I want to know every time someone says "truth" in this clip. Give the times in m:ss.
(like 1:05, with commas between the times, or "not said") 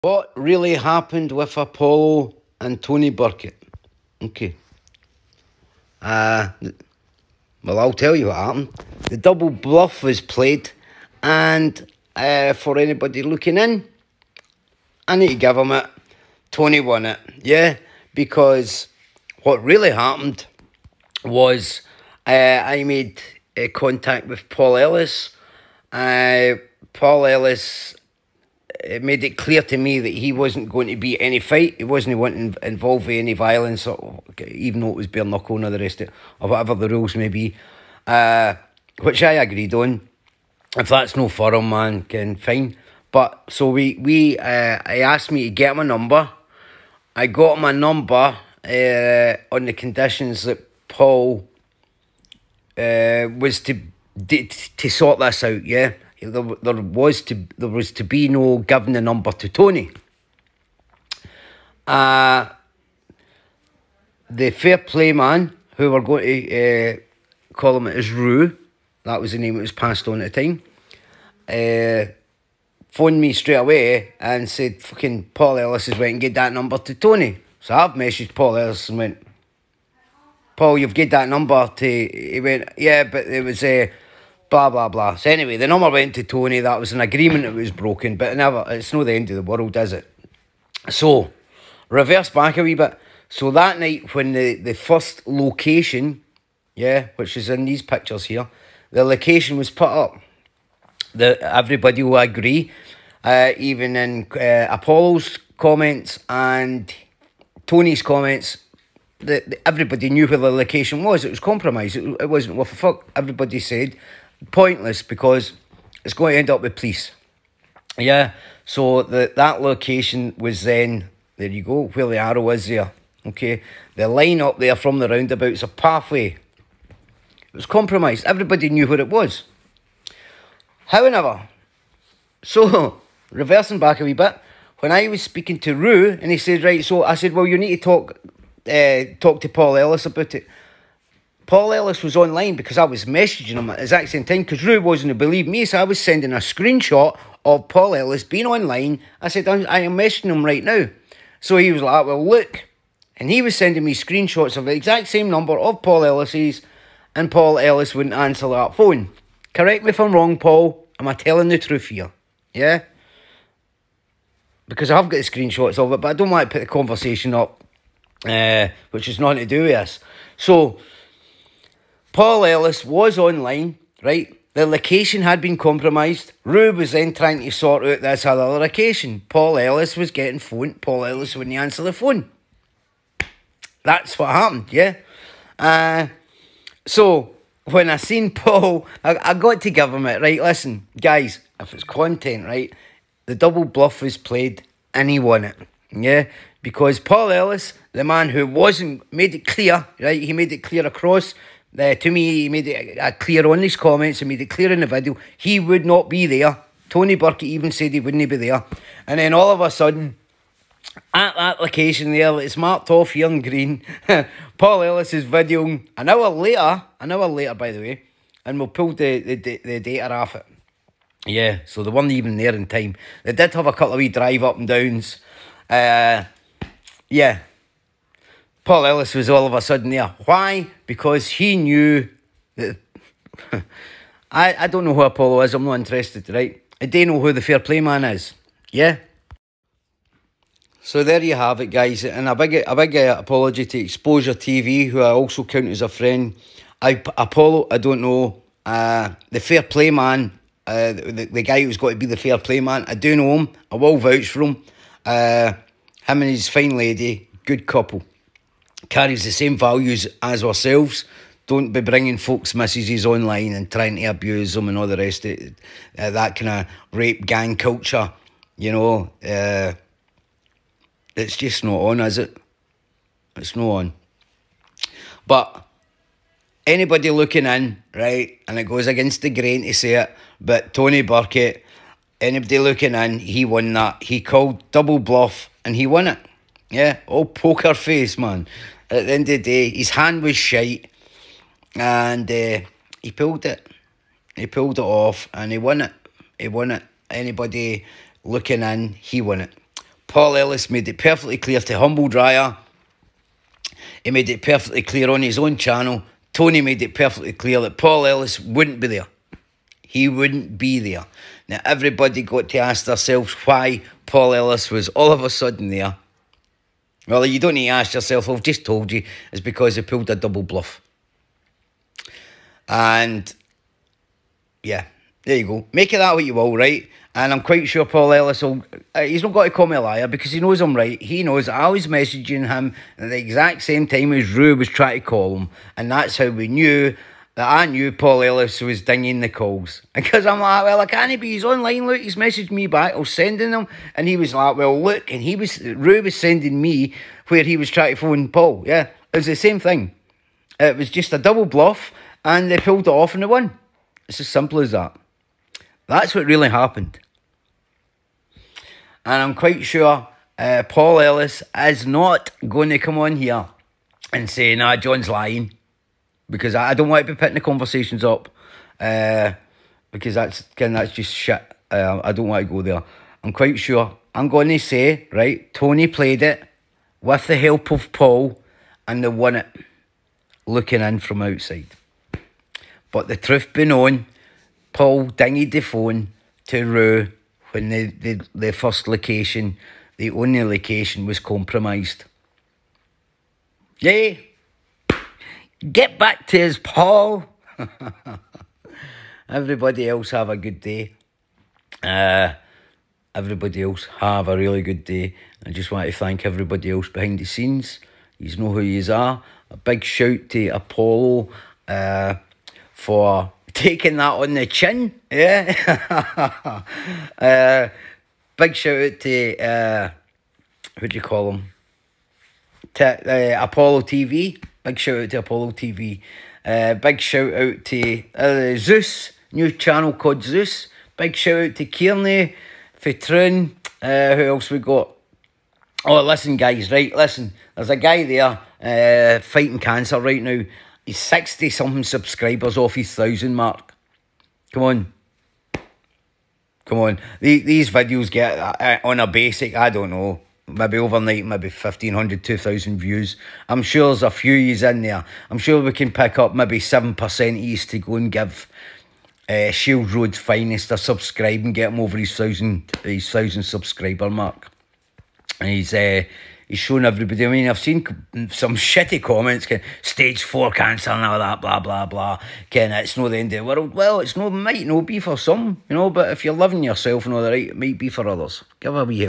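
2:41, 6:23.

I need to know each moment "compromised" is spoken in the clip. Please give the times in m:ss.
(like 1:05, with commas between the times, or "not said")
1:51, 2:07, 2:55, 6:31.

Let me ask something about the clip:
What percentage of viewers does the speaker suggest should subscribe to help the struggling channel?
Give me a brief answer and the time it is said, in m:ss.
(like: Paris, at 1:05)
7%, at 7:36.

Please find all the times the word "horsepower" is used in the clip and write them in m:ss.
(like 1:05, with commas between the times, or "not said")
not said.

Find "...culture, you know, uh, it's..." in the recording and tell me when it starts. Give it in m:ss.
4:27.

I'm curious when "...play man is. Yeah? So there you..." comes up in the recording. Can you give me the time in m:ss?
3:57.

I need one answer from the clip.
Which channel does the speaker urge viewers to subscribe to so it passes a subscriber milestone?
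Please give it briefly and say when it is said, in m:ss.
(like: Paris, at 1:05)
Shield Road Finest, at 7:39.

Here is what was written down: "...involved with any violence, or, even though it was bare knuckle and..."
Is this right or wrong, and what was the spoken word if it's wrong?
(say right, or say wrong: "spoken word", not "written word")
right.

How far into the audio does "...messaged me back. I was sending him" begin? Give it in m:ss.
5:42.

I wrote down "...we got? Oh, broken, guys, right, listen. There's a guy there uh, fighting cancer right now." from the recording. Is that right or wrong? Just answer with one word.
wrong.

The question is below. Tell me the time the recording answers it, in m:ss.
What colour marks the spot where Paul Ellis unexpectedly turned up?
3:33.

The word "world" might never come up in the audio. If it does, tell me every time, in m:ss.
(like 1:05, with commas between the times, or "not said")
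1:29, 7:53.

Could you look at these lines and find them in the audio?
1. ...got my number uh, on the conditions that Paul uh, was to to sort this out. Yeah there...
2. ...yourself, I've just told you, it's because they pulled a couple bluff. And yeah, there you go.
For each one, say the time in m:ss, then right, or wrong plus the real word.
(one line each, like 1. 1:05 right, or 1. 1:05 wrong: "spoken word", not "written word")
1. 0:47 right
2. 5:17 wrong: "double", not "couple".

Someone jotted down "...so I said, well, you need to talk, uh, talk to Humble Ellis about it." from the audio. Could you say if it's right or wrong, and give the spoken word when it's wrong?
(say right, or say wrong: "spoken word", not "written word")
wrong: "Paul", not "Humble".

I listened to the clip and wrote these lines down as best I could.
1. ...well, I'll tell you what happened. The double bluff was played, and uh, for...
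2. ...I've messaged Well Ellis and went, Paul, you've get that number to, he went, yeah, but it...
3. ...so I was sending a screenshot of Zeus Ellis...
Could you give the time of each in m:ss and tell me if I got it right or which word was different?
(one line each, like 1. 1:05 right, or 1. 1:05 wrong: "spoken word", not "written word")
1. 0:07 right
2. 1:17 wrong: "Paul", not "Well"
3. 2:25 wrong: "Paul", not "Zeus".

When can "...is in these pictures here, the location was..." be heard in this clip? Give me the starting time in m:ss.
1:37.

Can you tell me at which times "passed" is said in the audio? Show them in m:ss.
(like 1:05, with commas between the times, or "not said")
1:09.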